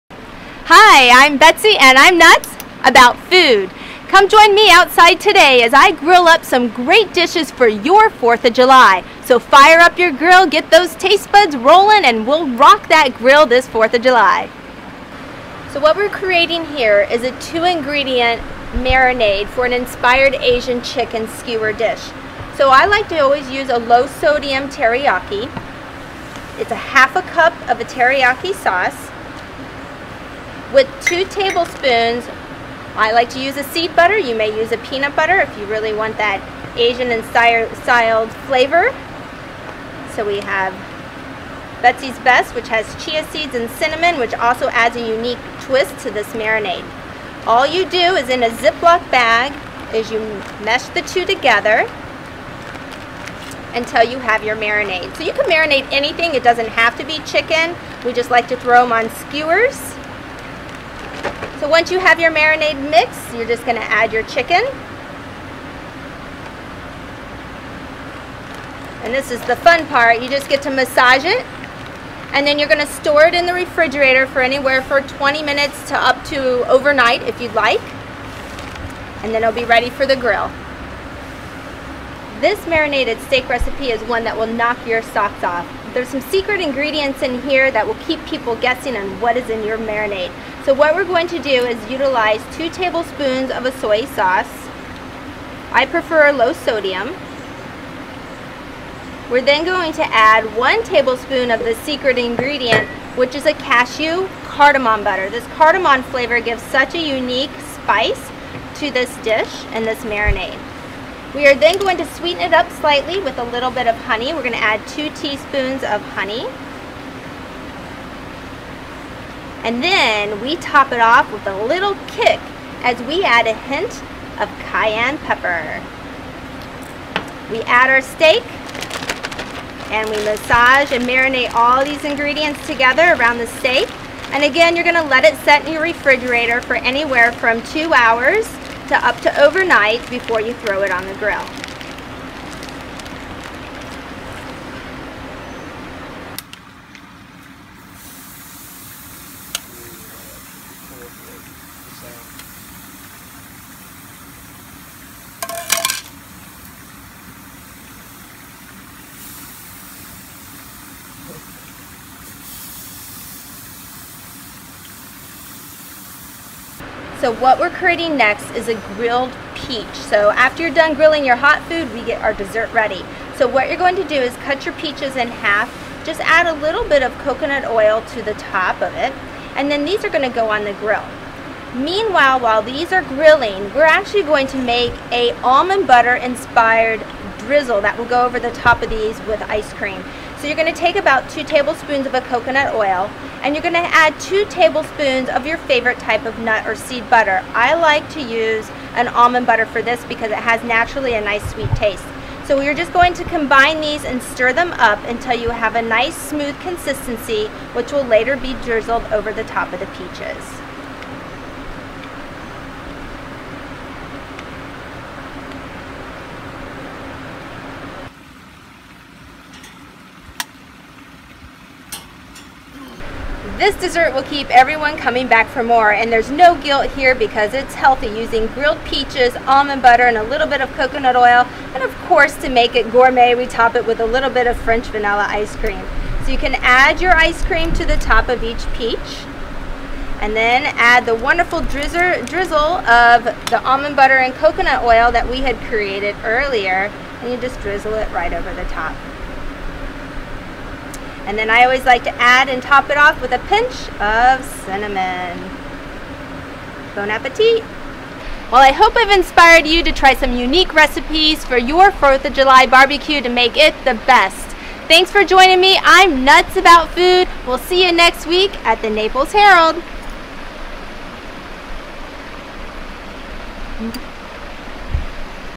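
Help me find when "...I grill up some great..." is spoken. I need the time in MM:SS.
00:05.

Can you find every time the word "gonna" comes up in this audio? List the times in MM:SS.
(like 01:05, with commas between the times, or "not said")
01:03, 01:12, 02:14, 03:00.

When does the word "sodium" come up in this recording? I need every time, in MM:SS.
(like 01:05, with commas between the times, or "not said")
00:24, 01:36.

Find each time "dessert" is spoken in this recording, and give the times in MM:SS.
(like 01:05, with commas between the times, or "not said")
02:52, 03:43.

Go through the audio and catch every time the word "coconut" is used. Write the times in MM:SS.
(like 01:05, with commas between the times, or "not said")
02:57, 03:12, 03:50, 04:04.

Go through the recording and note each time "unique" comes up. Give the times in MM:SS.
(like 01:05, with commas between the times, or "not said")
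00:45, 01:47, 04:20.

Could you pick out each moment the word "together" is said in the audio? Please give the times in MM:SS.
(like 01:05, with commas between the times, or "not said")
00:51, 02:12.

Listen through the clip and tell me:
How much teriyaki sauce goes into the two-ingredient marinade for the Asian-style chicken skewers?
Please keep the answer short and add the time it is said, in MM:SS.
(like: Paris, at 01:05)
1/2 cup, at 00:26.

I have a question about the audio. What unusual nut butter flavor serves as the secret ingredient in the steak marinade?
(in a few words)
Cashew cardamom butter.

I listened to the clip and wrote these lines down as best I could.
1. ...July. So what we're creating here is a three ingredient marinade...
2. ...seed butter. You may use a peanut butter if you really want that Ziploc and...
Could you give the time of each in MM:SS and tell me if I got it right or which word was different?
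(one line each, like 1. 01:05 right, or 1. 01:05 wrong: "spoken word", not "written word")
1. 00:14 wrong: "two", not "three"
2. 00:33 wrong: "Asian", not "Ziploc".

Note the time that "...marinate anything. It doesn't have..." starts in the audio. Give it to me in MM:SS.
00:55.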